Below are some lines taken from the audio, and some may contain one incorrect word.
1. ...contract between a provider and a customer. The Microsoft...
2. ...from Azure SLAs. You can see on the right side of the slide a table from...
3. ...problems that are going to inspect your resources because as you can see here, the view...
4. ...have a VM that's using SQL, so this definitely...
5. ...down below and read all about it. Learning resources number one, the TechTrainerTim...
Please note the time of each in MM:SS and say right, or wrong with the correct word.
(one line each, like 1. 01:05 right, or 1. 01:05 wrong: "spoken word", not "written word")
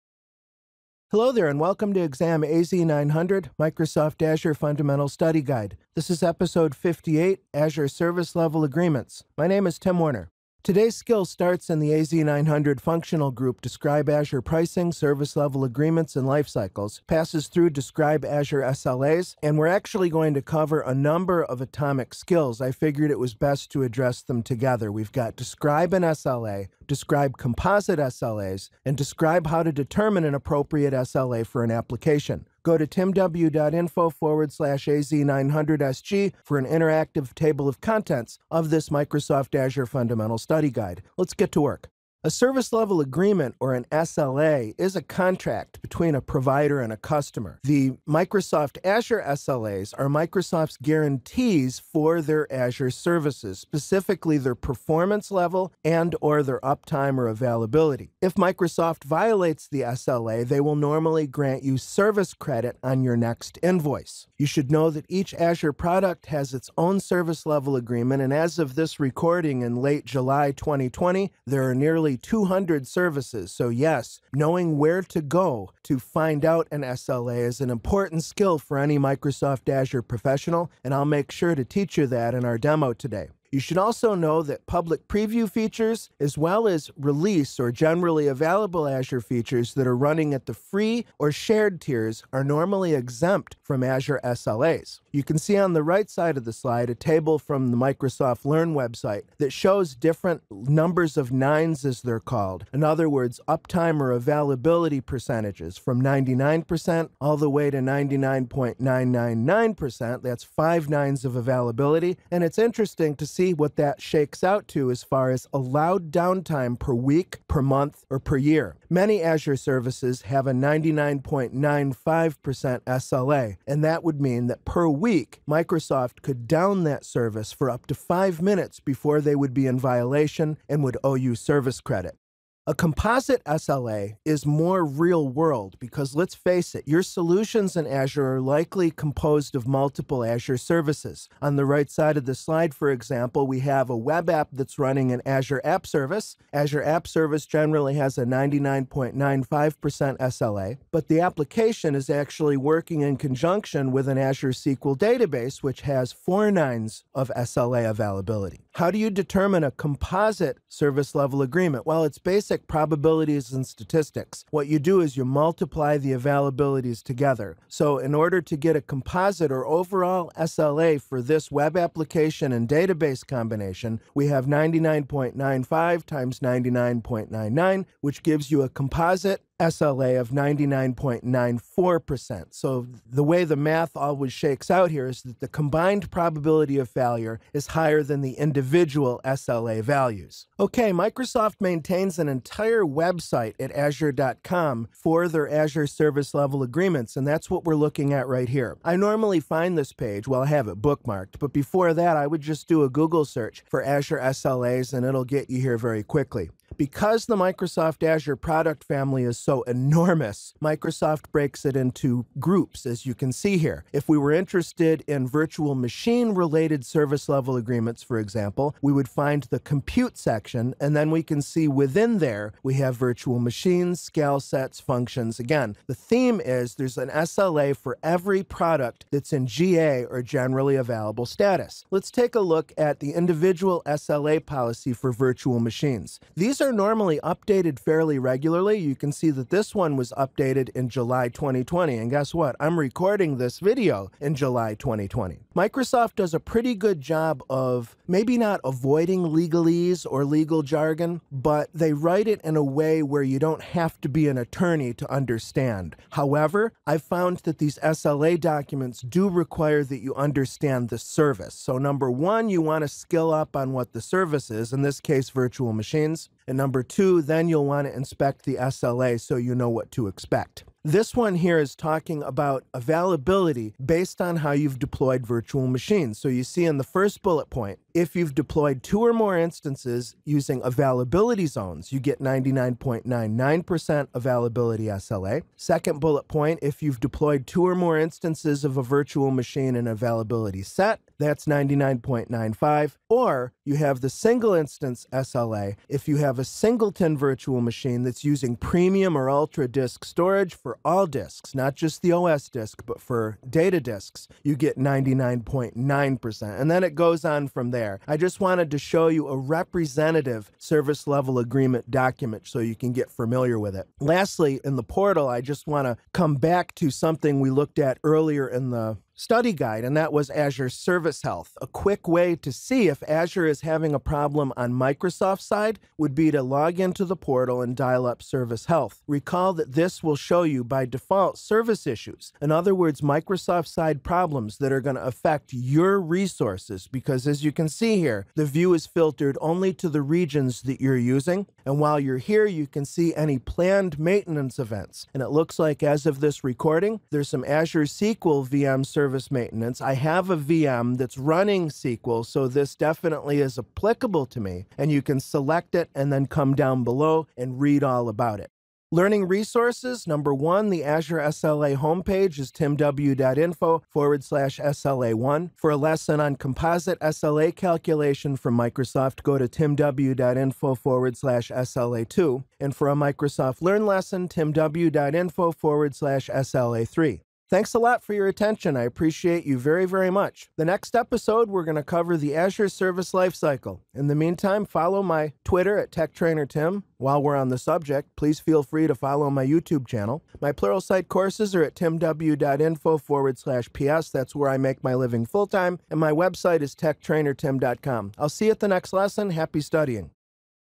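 1. 00:45 right
2. 01:33 right
3. 05:34 wrong: "affect", not "inspect"
4. 05:49 wrong: "running", not "using"
5. 05:56 wrong: "Azure", not "TechTrainerTim".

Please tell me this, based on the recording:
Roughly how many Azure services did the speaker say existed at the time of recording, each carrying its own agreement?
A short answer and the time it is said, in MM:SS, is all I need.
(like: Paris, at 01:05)
nearly 200, at 01:12.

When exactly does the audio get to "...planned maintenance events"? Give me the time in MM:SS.
05:43.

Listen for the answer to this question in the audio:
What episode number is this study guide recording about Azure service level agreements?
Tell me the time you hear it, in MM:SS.
00:06.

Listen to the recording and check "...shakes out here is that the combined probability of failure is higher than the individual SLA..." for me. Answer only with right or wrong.
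right.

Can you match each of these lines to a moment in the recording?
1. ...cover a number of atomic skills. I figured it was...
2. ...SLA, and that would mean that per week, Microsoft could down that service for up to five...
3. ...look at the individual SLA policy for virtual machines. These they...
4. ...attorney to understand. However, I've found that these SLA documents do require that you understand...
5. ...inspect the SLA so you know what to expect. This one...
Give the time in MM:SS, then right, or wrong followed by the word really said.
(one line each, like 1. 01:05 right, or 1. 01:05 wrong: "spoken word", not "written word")
1. 00:20 right
2. 02:02 right
3. 03:52 right
4. 04:14 right
5. 04:27 right.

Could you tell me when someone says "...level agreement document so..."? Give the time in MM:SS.
05:11.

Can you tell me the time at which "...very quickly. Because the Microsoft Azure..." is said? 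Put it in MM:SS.
03:25.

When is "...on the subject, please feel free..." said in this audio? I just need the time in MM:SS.
06:27.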